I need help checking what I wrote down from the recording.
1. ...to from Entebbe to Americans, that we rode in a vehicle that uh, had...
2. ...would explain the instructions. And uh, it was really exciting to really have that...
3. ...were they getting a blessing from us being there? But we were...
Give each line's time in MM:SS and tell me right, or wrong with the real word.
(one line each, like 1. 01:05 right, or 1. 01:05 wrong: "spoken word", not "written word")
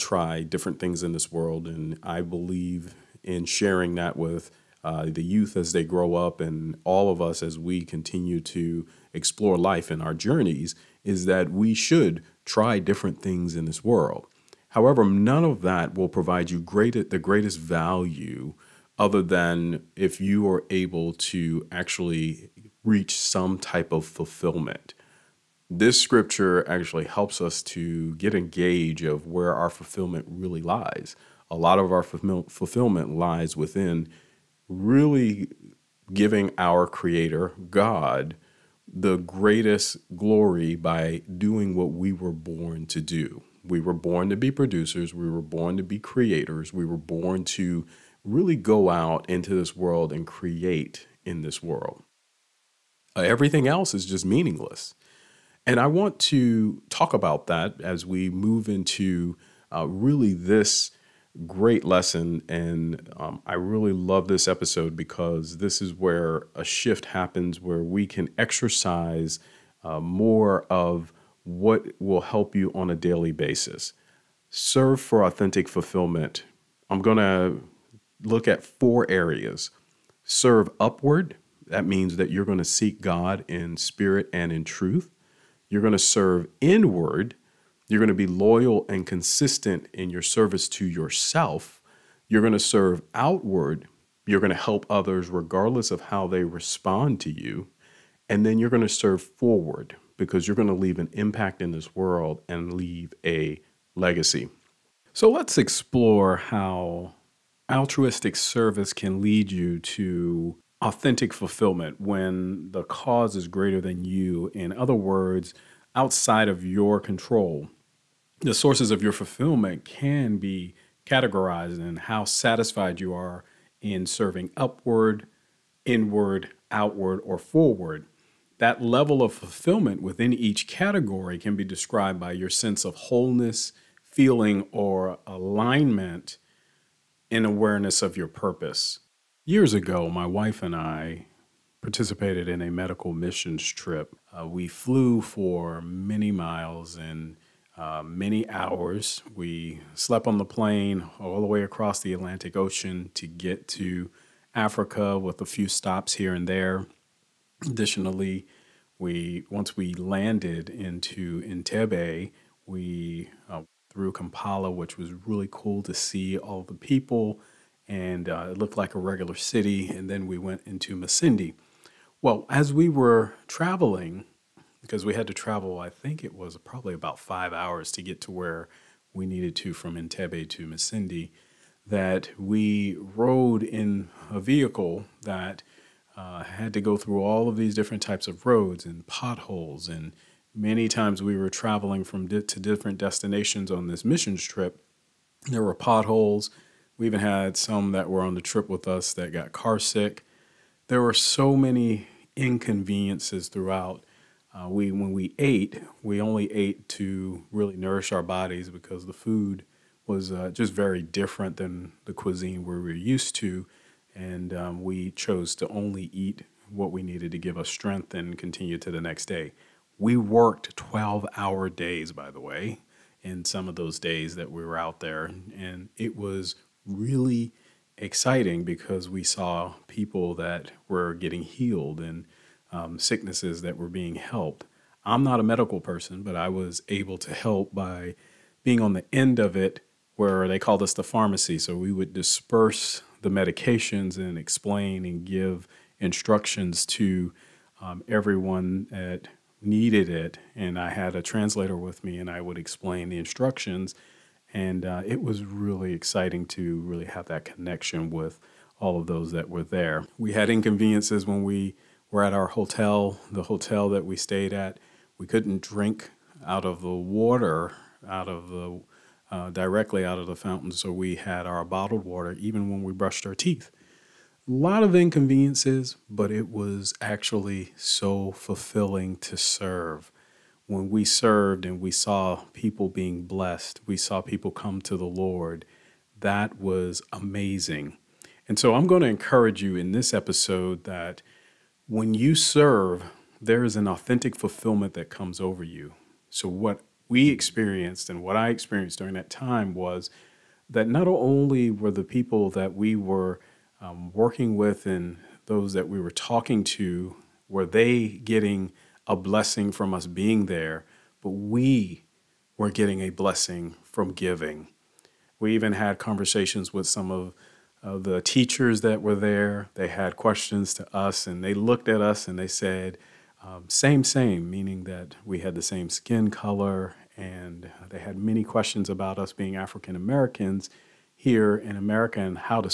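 1. 02:59 wrong: "Masindi", not "Americans"
2. 04:12 right
3. 05:07 right.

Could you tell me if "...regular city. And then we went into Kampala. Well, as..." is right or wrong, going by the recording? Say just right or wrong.
wrong.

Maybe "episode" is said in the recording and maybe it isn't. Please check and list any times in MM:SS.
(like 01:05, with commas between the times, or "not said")
01:04, 04:50.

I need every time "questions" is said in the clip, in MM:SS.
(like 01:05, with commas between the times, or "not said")
05:20, 05:28.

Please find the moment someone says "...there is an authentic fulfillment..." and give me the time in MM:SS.
04:53.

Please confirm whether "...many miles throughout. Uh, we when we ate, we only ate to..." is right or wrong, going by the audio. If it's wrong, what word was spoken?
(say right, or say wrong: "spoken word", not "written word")
wrong: "inconveniences", not "miles".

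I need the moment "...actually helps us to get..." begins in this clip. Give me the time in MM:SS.
00:26.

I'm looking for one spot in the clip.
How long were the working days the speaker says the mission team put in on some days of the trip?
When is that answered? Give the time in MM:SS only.
03:40.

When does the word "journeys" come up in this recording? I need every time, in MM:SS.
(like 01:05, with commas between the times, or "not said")
00:10.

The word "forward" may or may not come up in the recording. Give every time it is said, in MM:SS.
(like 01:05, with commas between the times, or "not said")
01:39, 02:07.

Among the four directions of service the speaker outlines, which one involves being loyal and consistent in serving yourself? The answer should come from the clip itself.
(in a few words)
Serve inward.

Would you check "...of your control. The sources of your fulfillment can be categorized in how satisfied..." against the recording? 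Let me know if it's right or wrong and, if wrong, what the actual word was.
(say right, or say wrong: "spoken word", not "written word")
right.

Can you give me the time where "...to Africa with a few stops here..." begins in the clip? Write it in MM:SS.
02:33.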